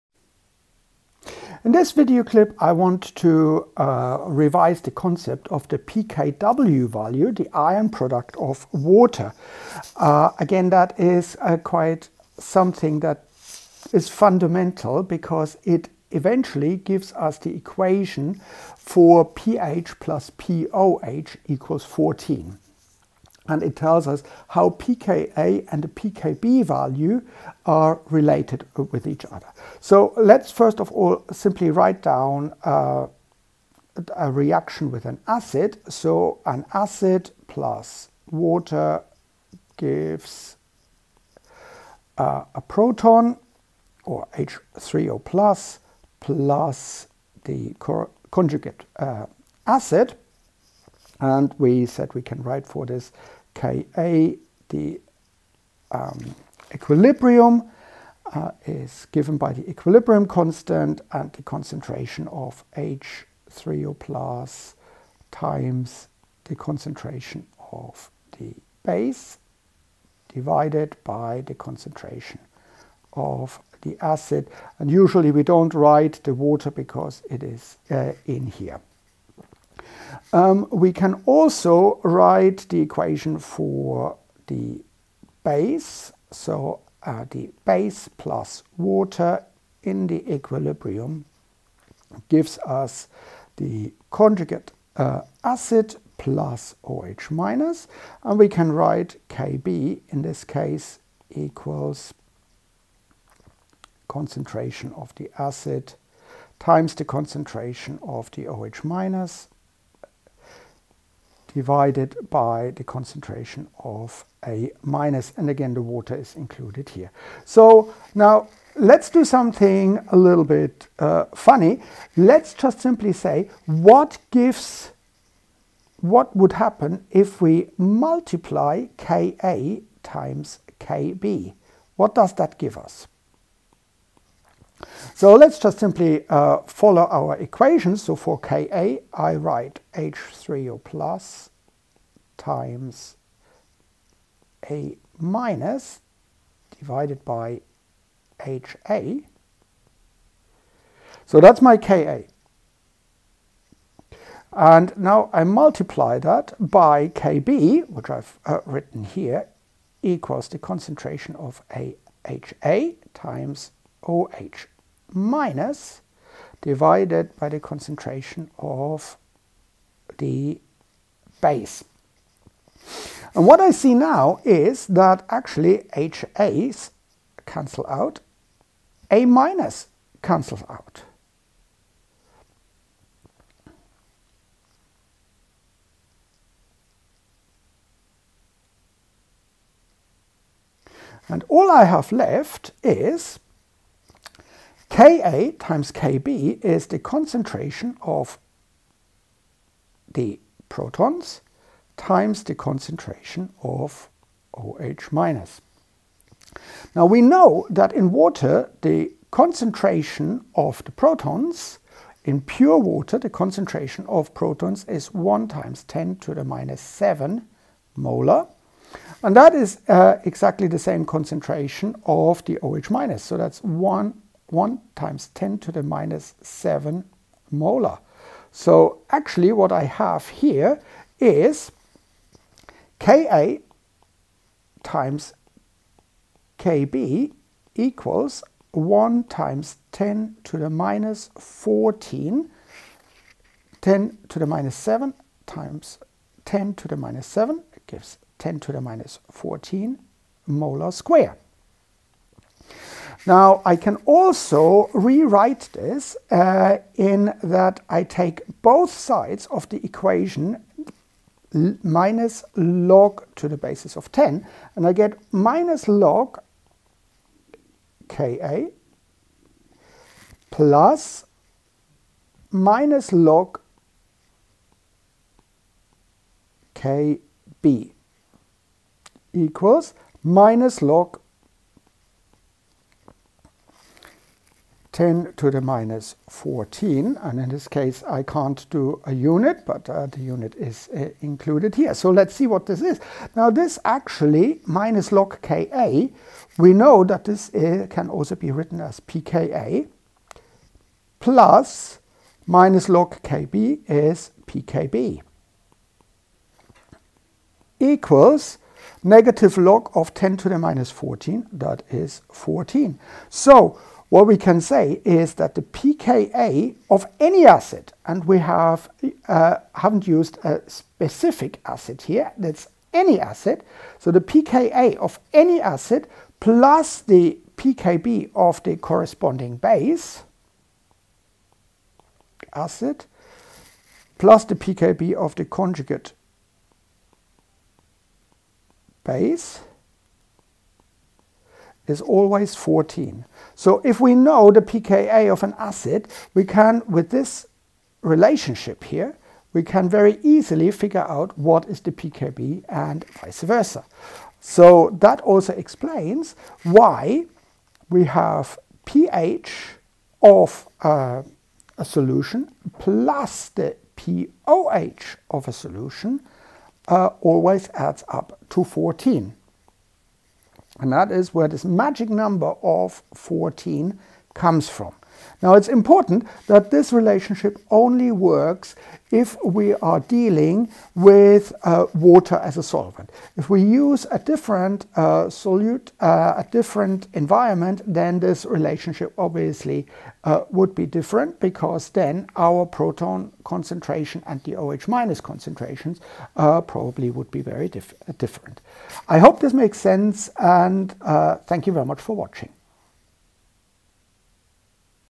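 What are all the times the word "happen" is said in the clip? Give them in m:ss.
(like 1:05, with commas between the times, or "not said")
2:06.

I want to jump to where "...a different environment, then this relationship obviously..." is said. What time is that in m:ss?
6:26.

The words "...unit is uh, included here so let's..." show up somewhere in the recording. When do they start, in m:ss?
4:50.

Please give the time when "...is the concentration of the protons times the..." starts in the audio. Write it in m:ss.
3:16.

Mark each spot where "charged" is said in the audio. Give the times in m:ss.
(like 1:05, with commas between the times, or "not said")
not said.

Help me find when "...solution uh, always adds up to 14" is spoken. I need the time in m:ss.
6:05.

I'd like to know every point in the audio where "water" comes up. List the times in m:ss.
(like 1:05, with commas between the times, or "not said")
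0:08, 0:38, 1:16, 1:28, 1:55, 3:28, 3:32, 6:21.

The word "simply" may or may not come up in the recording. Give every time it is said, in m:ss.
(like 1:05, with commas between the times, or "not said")
0:31, 2:02, 2:15.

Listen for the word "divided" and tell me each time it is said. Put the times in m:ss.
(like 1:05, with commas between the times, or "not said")
1:10, 1:51, 2:26, 2:46.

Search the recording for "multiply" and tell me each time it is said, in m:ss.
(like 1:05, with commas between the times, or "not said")
2:07, 2:35.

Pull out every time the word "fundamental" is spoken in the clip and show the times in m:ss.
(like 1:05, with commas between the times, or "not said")
0:14.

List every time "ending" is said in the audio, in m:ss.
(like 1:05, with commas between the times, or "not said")
not said.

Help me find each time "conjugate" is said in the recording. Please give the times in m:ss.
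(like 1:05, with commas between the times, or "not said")
0:48, 1:34, 5:35.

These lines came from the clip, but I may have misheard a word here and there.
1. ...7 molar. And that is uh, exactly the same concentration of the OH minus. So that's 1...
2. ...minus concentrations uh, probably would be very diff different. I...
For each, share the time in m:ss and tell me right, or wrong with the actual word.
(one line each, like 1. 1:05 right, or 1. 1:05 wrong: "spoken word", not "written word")
1. 3:36 right
2. 6:34 right.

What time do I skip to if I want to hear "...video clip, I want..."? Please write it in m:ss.
0:01.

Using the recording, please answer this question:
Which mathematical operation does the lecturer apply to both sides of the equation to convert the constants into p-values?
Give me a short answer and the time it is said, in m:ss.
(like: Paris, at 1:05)
minus log base 10, at 4:21.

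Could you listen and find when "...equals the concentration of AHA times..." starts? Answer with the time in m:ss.
2:40.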